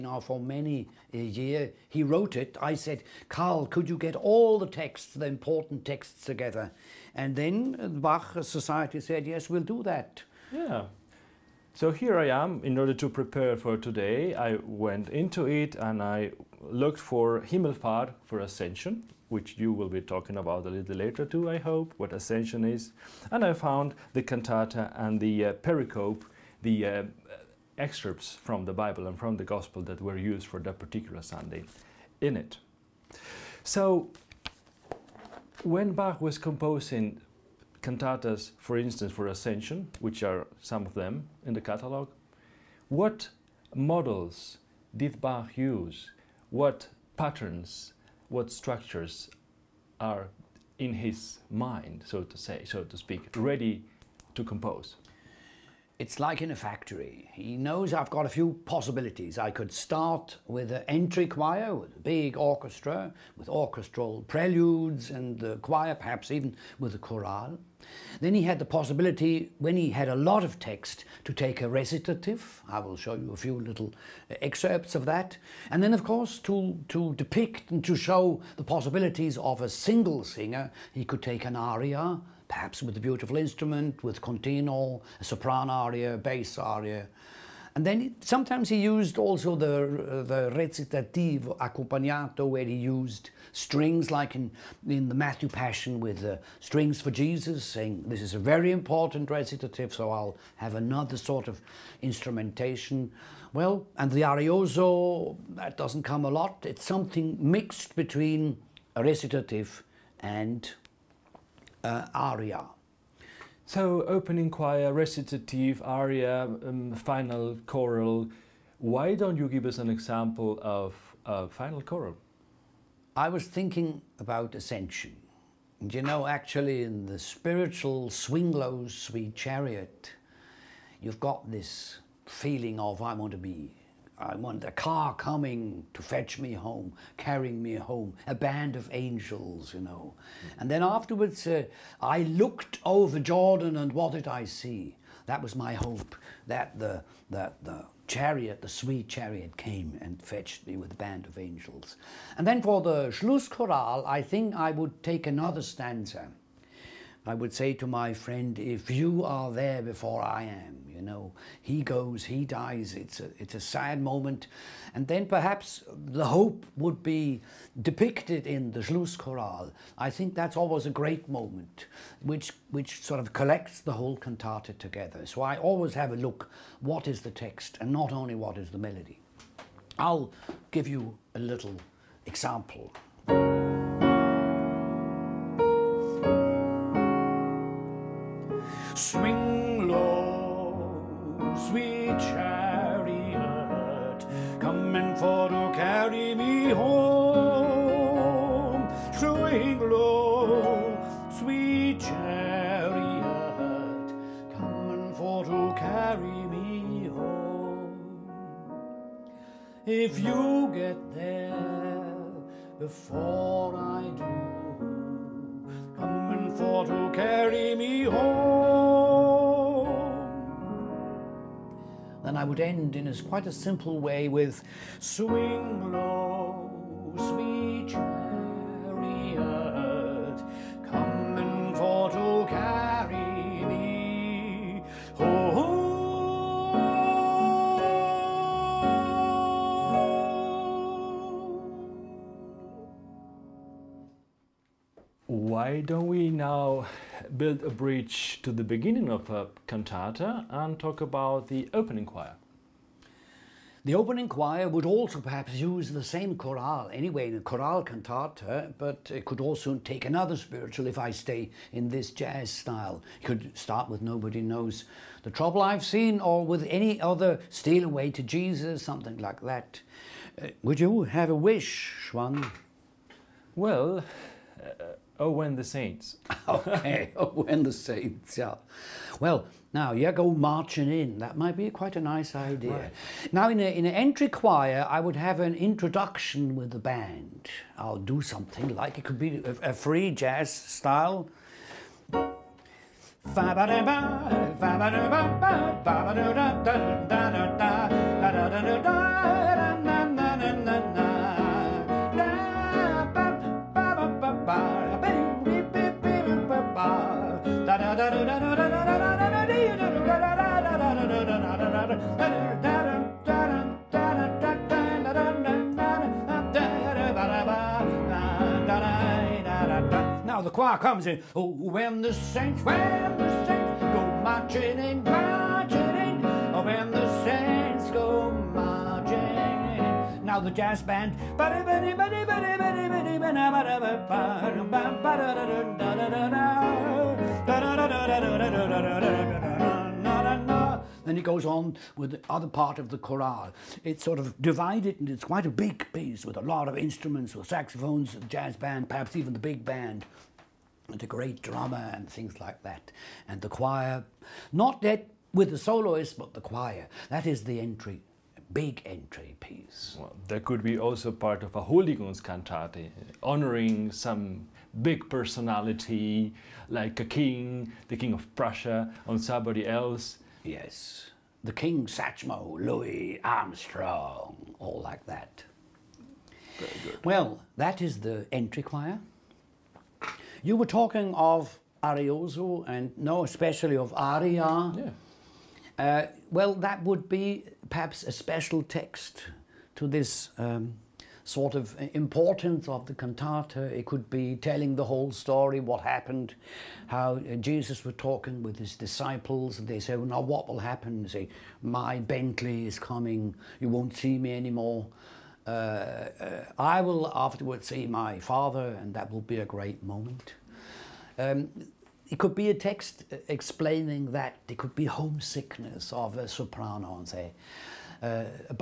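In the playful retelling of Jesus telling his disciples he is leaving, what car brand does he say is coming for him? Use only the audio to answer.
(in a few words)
Bentley.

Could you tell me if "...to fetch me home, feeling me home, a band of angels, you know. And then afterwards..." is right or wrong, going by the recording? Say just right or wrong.
wrong.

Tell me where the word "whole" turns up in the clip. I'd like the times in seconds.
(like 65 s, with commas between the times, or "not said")
173 s, 394 s.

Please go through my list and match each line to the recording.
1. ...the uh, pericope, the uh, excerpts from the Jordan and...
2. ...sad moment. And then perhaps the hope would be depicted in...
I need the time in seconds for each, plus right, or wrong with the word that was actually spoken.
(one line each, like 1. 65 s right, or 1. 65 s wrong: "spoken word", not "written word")
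1. 25 s wrong: "Bible", not "Jordan"
2. 163 s right.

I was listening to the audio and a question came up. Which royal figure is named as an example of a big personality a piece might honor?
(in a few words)
The King of Prussia.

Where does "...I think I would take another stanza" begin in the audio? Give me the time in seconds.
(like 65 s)
154 s.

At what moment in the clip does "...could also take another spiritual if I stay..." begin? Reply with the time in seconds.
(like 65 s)
259 s.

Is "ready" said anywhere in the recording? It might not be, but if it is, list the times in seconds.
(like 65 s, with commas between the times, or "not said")
53 s.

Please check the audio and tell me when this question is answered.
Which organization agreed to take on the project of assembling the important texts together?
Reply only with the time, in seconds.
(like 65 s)
8 s.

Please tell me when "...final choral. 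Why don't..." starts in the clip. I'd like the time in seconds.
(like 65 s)
116 s.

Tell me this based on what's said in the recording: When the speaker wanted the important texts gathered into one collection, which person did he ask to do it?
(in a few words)
Karl.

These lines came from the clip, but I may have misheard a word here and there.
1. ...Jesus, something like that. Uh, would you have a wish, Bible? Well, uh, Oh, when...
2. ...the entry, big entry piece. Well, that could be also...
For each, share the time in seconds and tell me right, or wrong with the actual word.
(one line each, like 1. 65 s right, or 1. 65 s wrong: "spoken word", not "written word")
1. 268 s wrong: "Xoán", not "Bible"
2. 357 s right.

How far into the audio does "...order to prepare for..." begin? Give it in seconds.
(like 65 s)
12 s.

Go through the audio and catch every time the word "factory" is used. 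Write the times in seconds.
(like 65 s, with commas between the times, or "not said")
56 s.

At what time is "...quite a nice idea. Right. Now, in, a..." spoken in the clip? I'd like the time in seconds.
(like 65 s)
281 s.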